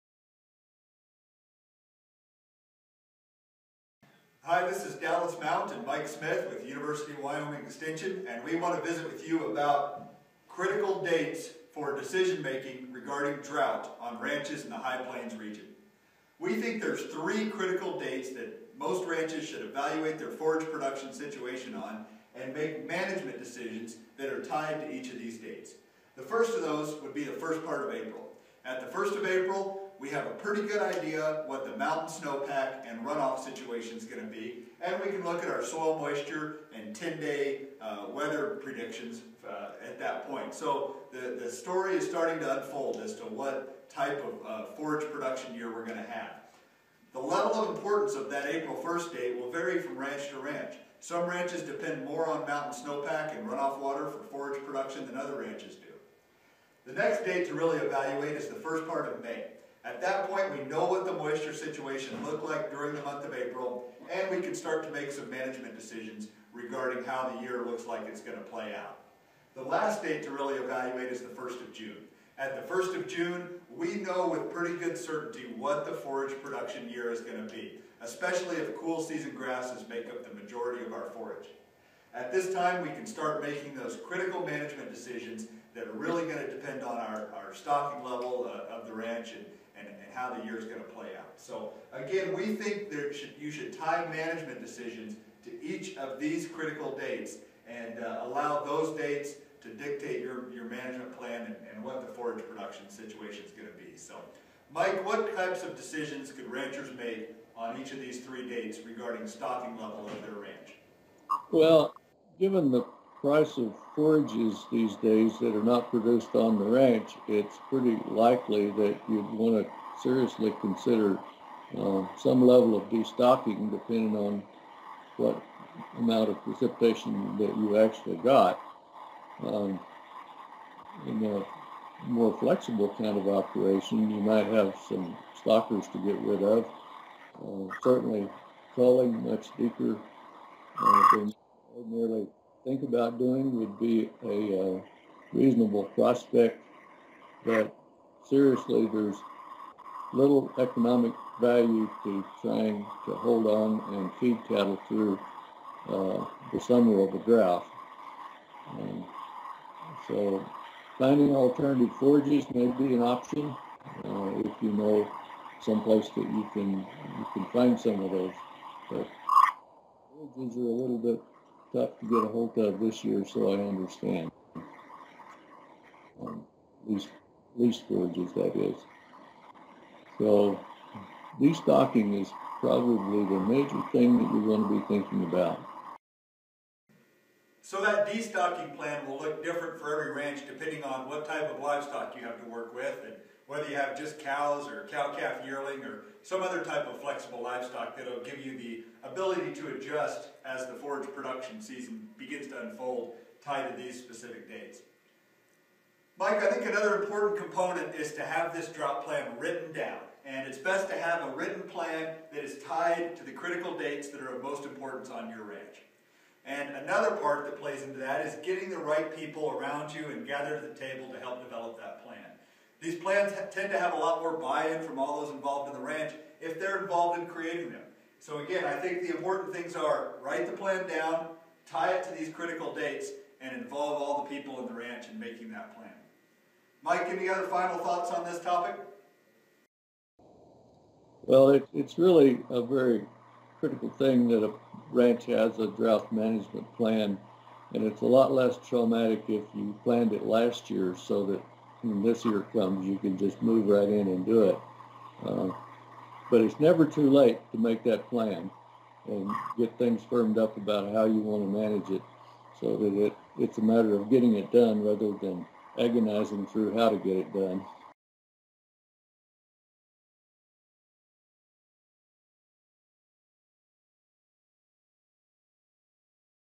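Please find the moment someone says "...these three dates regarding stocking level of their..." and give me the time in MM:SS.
01:47.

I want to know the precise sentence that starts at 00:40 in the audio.
So the, the story is starting to unfold as to what type of uh, forage production year we're going to have.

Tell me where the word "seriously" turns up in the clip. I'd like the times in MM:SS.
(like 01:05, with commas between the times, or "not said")
02:00, 02:28.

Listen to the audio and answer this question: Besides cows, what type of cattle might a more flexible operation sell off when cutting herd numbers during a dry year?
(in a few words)
stockers.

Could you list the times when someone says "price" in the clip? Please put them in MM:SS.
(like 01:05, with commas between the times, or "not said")
01:53.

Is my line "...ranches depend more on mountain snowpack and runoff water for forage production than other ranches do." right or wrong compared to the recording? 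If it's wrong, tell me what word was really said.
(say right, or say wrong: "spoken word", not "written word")
right.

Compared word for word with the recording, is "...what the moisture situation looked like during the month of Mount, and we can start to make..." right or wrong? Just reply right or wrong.
wrong.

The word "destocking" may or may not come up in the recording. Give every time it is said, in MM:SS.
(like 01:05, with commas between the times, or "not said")
02:02, 03:01, 03:08.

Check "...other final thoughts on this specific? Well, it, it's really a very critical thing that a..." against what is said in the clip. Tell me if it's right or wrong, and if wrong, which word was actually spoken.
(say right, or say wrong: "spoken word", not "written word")
wrong: "topic", not "specific".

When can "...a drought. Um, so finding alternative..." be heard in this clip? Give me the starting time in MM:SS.
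02:37.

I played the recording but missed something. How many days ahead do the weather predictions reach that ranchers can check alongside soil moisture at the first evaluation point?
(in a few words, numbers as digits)
10.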